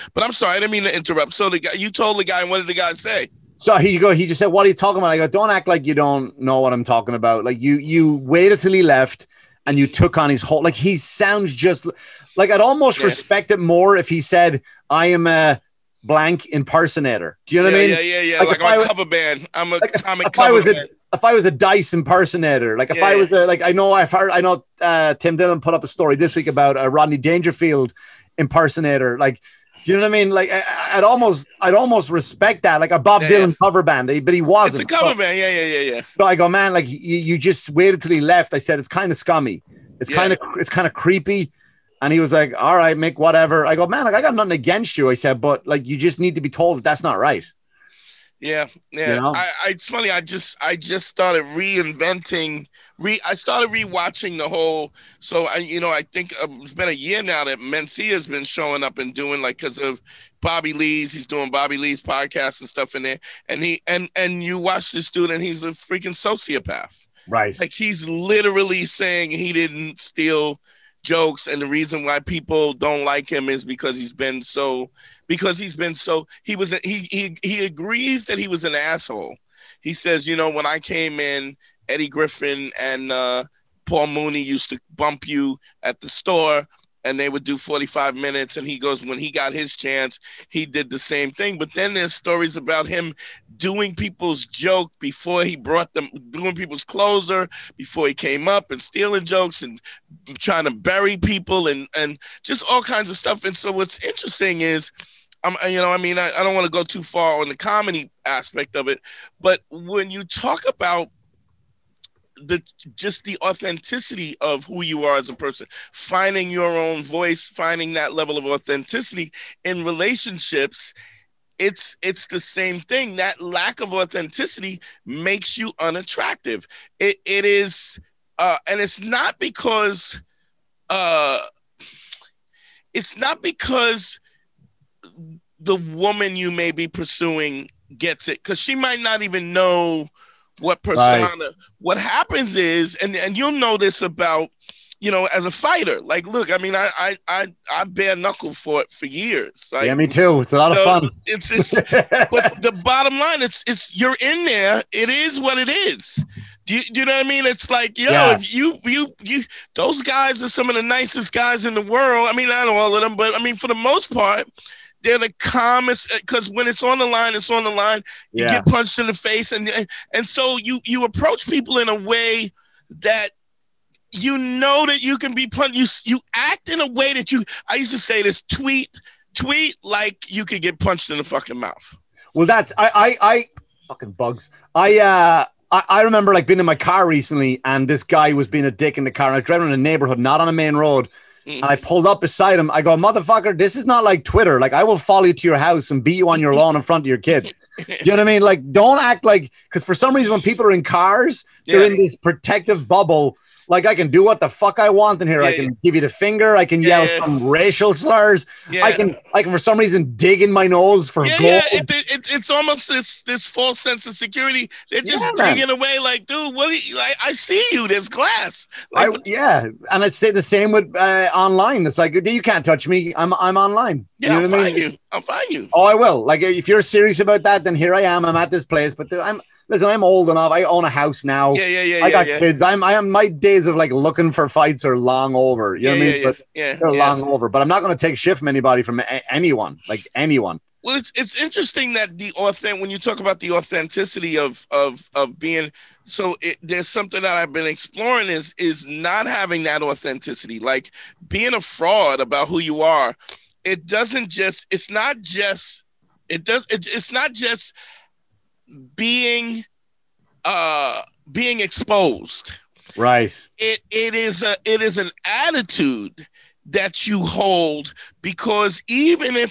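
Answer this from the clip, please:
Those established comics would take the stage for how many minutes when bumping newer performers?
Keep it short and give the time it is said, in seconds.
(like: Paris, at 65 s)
45, at 87 s.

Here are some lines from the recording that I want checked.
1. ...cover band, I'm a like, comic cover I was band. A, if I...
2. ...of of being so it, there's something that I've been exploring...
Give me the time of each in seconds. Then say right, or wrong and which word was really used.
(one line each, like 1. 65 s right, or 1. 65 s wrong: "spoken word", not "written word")
1. 18 s right
2. 244 s right.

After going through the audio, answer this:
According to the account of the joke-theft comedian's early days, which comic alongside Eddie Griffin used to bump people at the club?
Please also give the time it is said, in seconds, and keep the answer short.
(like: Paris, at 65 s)
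Paul Mooney, at 83 s.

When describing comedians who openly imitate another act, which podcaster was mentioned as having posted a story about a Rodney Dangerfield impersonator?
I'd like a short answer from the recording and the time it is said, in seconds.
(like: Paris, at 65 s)
Tim Dillon, at 25 s.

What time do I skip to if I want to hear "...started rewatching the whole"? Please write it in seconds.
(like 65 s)
53 s.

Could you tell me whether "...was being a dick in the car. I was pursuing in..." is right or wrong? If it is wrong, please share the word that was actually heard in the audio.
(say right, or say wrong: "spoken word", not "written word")
wrong: "driving", not "pursuing".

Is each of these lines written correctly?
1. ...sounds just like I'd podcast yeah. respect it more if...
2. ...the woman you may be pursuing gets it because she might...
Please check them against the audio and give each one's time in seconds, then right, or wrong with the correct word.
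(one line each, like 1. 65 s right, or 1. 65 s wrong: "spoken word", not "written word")
1. 10 s wrong: "almost", not "podcast"
2. 135 s right.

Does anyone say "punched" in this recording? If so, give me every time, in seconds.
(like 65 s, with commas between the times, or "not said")
168 s, 175 s, 180 s.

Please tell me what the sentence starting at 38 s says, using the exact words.
I said it's kind of scummy, it's yeah.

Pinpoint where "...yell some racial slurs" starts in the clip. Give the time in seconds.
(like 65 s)
206 s.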